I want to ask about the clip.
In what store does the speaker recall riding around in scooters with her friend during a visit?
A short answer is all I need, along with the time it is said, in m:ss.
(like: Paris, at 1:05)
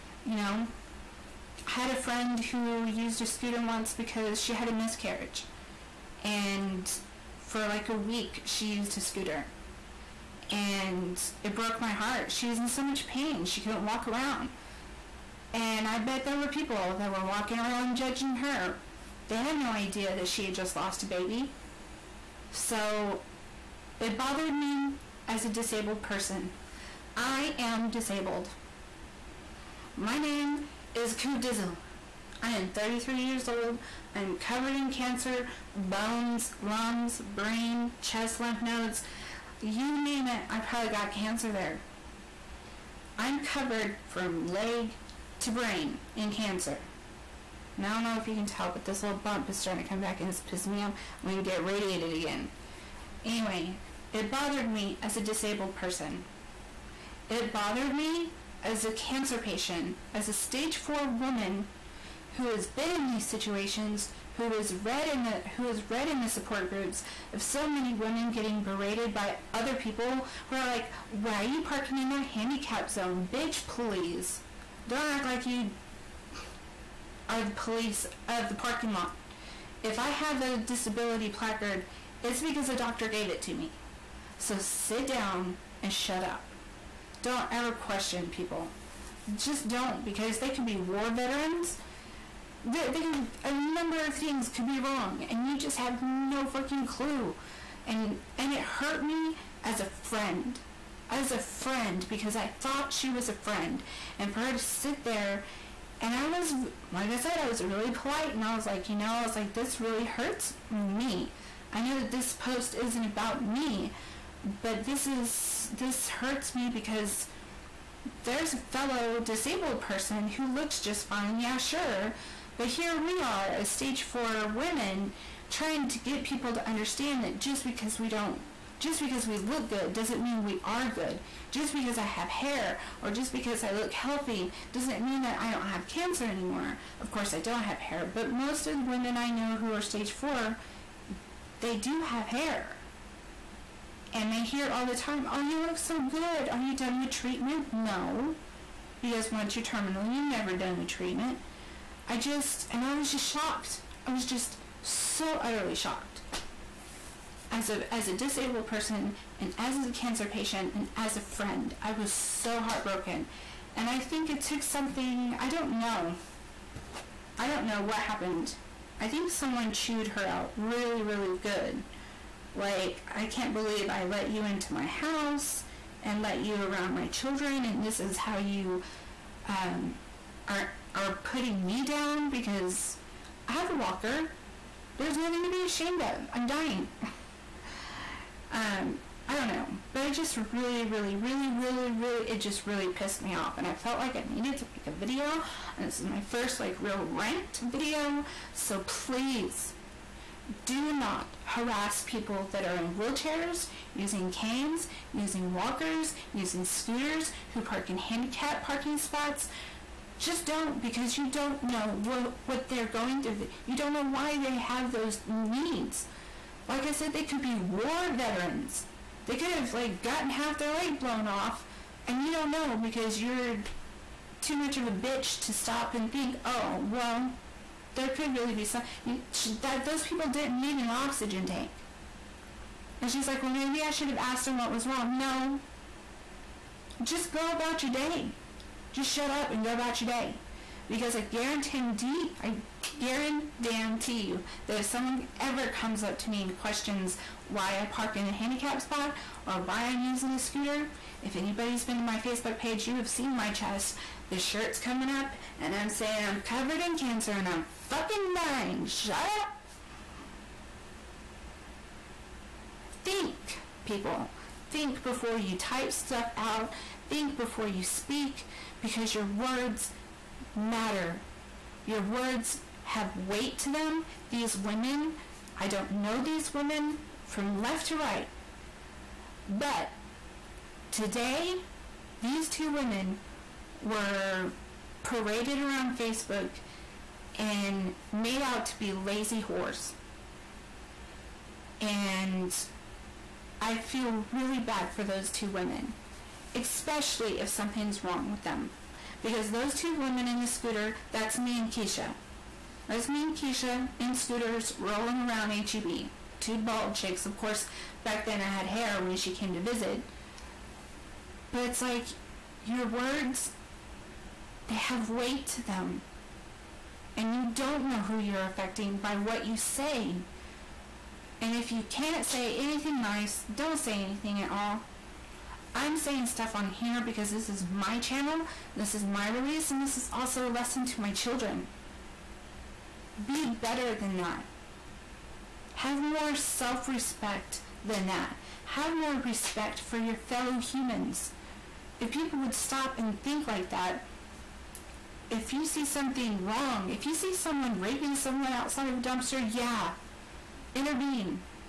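HEB, at 5:05.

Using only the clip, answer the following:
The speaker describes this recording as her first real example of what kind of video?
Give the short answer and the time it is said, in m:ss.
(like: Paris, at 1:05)
rant video, at 3:17.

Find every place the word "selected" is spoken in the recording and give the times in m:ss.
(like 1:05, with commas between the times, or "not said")
not said.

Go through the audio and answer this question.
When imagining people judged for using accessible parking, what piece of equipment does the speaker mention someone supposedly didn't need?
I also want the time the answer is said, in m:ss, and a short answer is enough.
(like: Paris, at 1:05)
oxygen tank, at 3:50.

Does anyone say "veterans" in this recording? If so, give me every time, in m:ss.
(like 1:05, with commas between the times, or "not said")
1:31, 3:38.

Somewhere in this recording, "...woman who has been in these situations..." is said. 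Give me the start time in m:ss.
1:01.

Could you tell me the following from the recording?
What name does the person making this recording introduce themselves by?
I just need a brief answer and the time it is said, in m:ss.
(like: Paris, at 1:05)
Coop Dizzle, at 0:31.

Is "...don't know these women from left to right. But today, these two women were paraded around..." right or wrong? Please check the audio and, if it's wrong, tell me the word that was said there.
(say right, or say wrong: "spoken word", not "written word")
right.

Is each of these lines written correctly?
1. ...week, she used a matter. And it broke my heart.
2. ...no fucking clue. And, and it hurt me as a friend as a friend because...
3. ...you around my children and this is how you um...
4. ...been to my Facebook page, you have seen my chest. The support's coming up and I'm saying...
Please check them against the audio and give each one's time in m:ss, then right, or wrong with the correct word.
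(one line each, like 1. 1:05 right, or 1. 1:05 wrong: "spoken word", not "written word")
1. 0:07 wrong: "scooter", not "matter"
2. 1:36 right
3. 2:56 right
4. 4:11 wrong: "shirt", not "support".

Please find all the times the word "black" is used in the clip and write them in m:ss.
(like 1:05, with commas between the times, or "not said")
not said.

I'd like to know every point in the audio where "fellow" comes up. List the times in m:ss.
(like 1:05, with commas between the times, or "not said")
1:58, 5:40.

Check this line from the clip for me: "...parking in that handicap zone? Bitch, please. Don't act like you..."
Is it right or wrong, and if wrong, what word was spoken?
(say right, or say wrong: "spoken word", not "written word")
right.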